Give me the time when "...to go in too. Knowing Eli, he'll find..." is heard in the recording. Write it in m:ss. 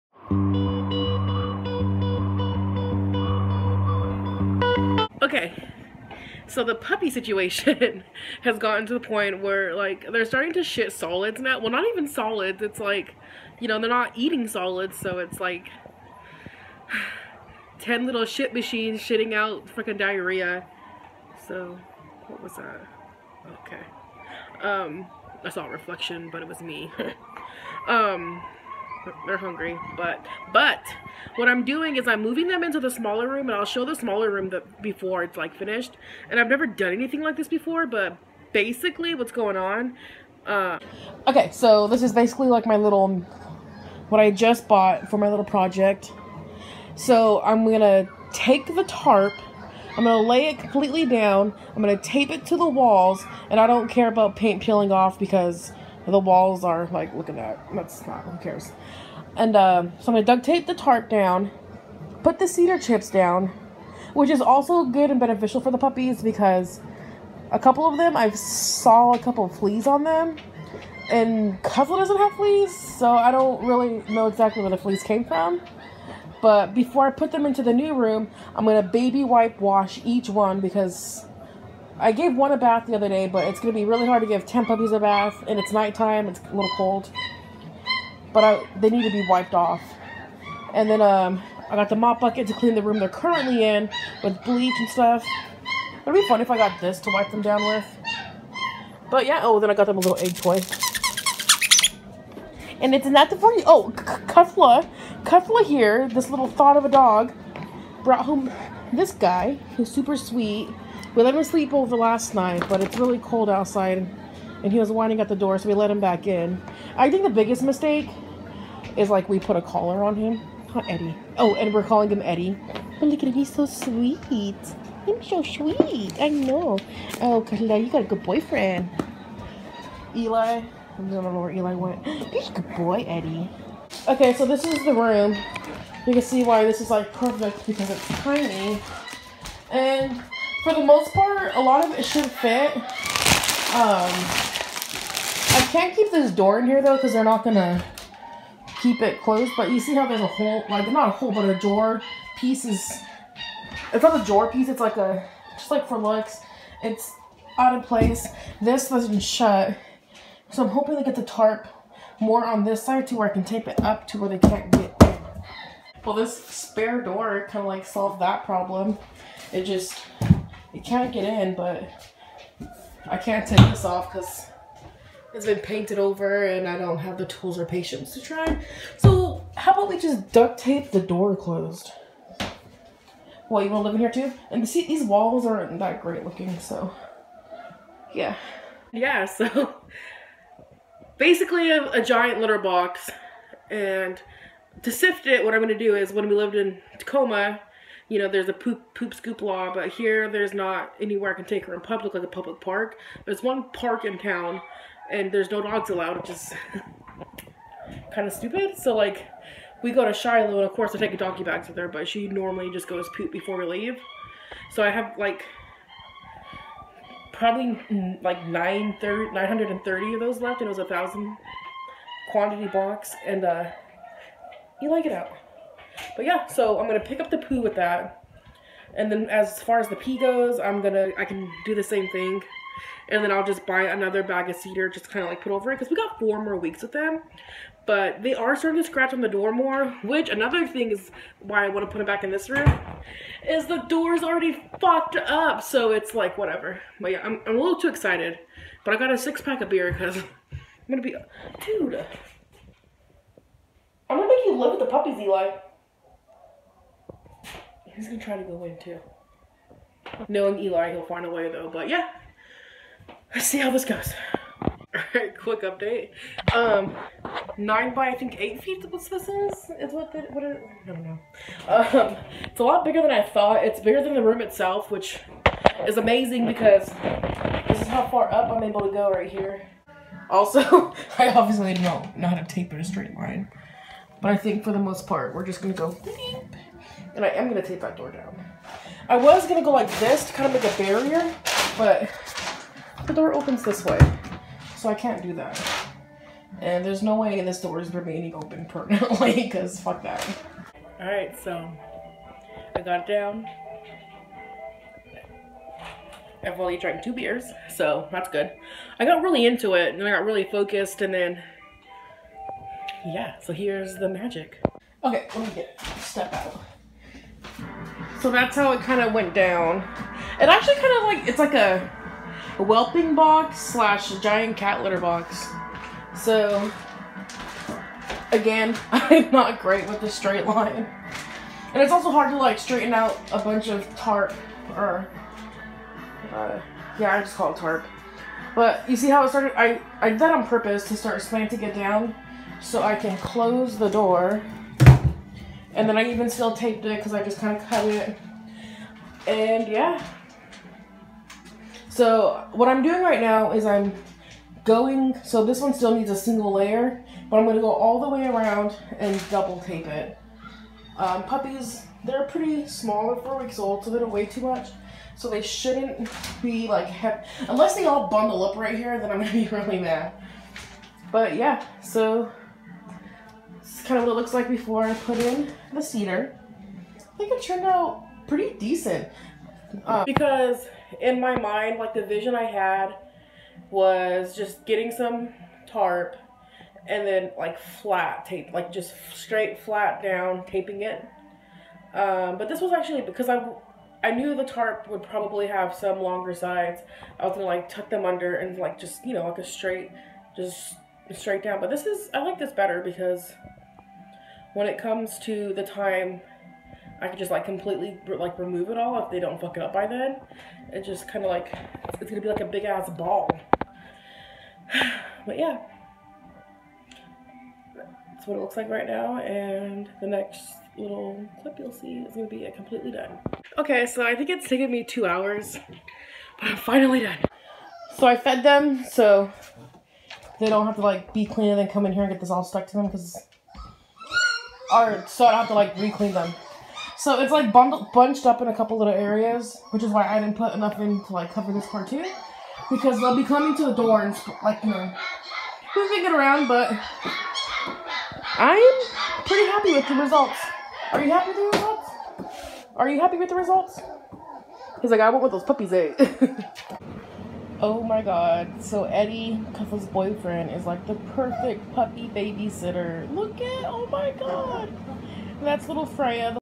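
4:18.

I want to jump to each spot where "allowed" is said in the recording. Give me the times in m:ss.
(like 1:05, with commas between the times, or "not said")
3:25.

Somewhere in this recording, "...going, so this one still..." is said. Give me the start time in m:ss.
5:54.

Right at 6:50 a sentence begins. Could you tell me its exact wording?
It just kind of like, it's gonna be like a big ass ball.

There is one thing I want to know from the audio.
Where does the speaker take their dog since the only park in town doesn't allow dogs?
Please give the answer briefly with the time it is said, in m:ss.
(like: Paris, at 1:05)
Shiloh, at 3:30.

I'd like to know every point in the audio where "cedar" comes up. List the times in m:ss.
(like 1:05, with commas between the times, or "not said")
1:02, 3:54, 6:15.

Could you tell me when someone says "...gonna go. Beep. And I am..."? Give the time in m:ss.
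4:45.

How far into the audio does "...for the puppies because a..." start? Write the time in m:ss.
1:05.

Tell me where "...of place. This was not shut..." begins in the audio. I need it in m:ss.
2:37.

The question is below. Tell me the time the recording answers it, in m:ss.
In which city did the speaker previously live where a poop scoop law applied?
3:16.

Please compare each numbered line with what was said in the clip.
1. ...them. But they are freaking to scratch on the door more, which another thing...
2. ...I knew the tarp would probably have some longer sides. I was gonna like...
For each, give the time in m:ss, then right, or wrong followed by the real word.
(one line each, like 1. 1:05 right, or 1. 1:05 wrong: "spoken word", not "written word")
1. 3:56 wrong: "starting", not "freaking"
2. 6:34 right.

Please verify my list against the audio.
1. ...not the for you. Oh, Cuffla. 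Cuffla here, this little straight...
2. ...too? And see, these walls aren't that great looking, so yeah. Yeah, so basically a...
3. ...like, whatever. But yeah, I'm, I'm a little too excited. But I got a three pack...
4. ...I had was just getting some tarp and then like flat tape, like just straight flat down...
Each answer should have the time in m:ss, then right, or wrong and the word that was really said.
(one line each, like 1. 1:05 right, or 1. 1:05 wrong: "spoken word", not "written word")
1. 1:43 wrong: "thought", not "straight"
2. 3:04 right
3. 4:06 wrong: "six", not "three"
4. 6:22 right.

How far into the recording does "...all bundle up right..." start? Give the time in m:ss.
6:07.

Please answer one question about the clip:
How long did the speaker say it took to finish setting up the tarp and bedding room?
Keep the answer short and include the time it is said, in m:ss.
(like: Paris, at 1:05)
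2 hours, at 7:04.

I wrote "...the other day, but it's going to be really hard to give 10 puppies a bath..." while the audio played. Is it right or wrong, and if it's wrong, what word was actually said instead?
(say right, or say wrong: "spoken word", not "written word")
right.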